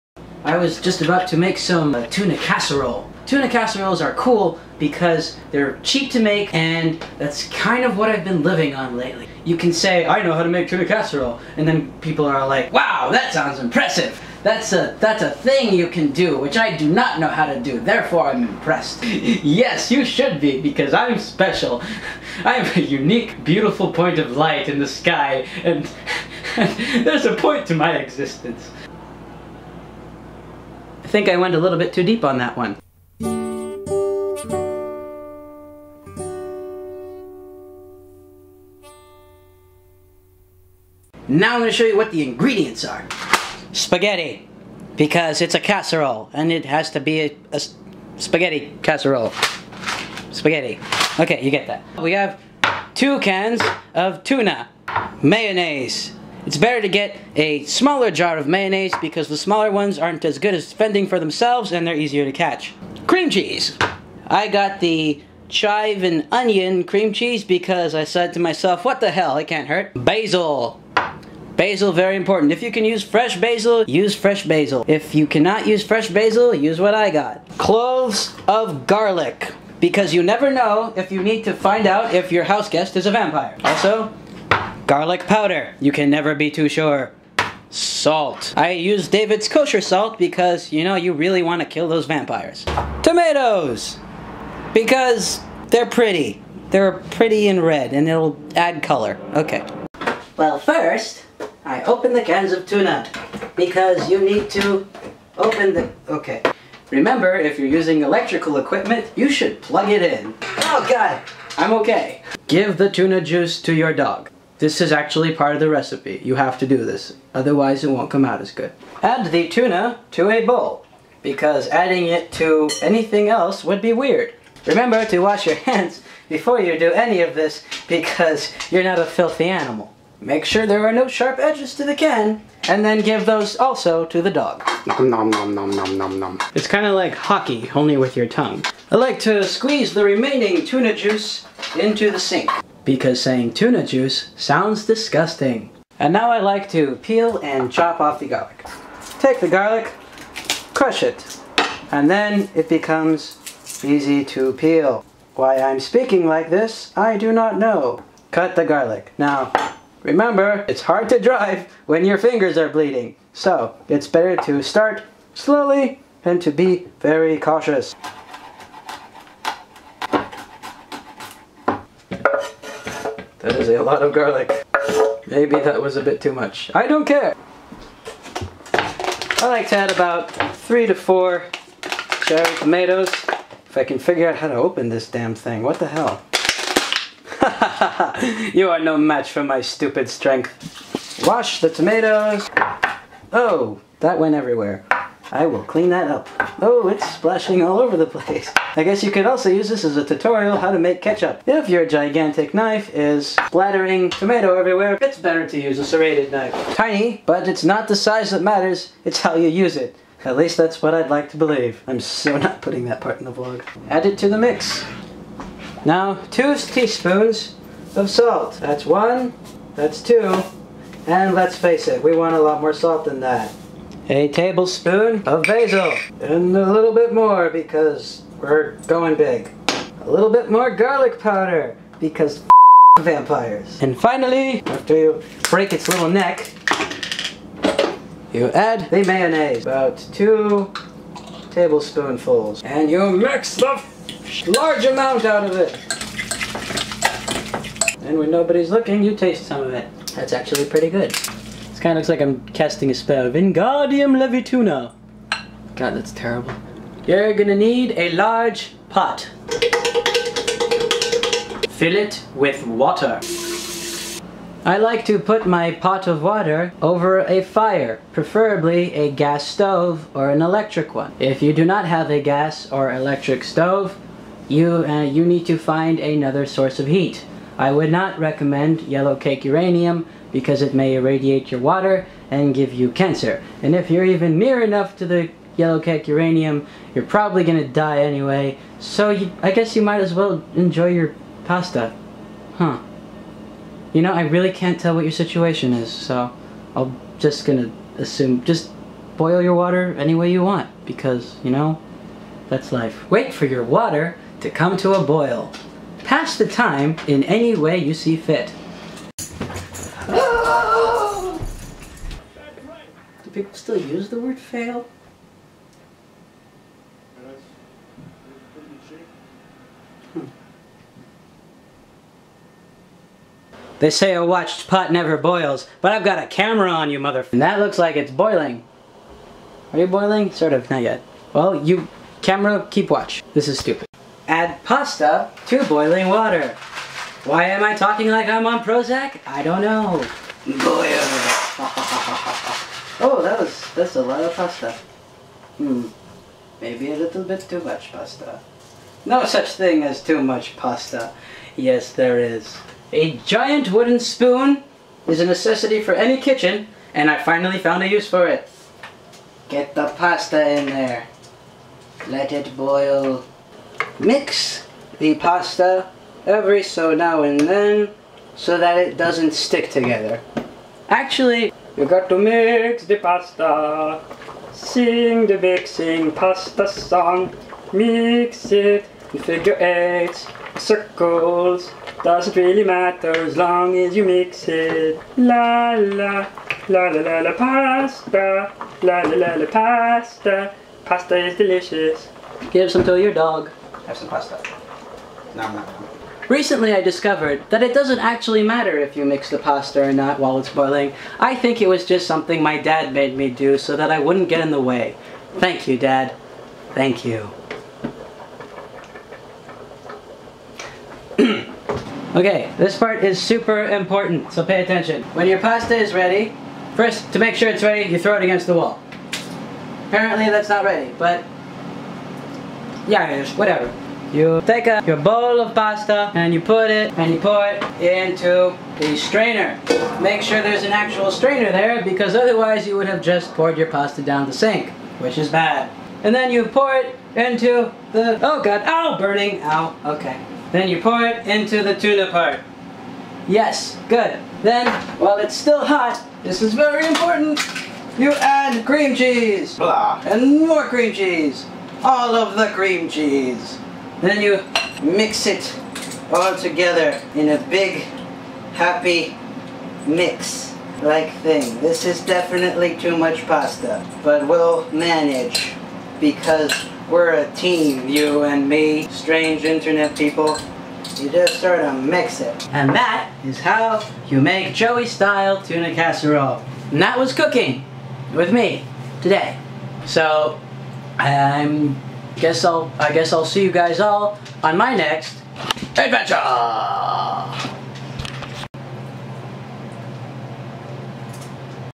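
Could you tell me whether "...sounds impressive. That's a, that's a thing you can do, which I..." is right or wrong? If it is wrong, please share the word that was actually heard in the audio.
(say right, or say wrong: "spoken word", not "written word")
right.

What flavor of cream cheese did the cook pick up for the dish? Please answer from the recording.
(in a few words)
chive and onion.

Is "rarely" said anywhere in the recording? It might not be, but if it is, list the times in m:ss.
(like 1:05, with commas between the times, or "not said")
not said.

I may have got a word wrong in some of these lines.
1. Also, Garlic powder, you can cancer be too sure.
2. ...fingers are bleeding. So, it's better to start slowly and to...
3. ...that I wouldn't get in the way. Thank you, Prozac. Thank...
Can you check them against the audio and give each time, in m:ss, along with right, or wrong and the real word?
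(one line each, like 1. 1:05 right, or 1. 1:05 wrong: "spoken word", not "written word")
1. 1:23 wrong: "never", not "cancer"
2. 2:42 right
3. 6:43 wrong: "Dad", not "Prozac".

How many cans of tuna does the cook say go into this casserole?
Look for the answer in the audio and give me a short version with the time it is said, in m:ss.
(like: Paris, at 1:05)
2, at 0:52.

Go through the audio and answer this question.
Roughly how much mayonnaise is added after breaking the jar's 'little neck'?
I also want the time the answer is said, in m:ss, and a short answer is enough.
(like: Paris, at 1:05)
2 tablespoons, at 4:00.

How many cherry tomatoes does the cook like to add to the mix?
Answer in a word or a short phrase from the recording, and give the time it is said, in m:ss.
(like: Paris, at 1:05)
3 to 4, at 3:00.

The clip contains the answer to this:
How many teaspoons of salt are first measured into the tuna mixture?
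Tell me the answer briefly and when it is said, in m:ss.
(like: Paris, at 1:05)
2, at 3:36.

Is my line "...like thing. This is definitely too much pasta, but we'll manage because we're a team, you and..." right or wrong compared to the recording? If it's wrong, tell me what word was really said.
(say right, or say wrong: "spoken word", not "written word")
right.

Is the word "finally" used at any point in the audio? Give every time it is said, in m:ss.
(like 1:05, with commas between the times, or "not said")
3:53, 5:57.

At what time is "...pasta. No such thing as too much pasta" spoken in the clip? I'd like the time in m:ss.
5:47.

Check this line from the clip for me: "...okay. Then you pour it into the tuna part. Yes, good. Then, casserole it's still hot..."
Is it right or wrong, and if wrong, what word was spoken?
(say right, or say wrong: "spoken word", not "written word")
wrong: "while", not "casserole".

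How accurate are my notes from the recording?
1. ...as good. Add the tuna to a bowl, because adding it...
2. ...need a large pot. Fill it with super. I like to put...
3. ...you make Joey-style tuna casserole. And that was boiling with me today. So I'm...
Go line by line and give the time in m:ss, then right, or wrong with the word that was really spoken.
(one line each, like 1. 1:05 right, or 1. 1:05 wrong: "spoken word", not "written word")
1. 1:58 right
2. 4:17 wrong: "water", not "super"
3. 7:54 wrong: "cooking", not "boiling".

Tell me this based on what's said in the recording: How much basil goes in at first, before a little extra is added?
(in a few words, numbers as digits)
a tablespoon.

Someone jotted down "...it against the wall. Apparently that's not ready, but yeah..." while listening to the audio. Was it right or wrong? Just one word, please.
right.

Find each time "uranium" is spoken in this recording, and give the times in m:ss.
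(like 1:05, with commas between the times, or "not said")
4:39, 4:46.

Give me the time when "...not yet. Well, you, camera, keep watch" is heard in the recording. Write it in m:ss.
5:30.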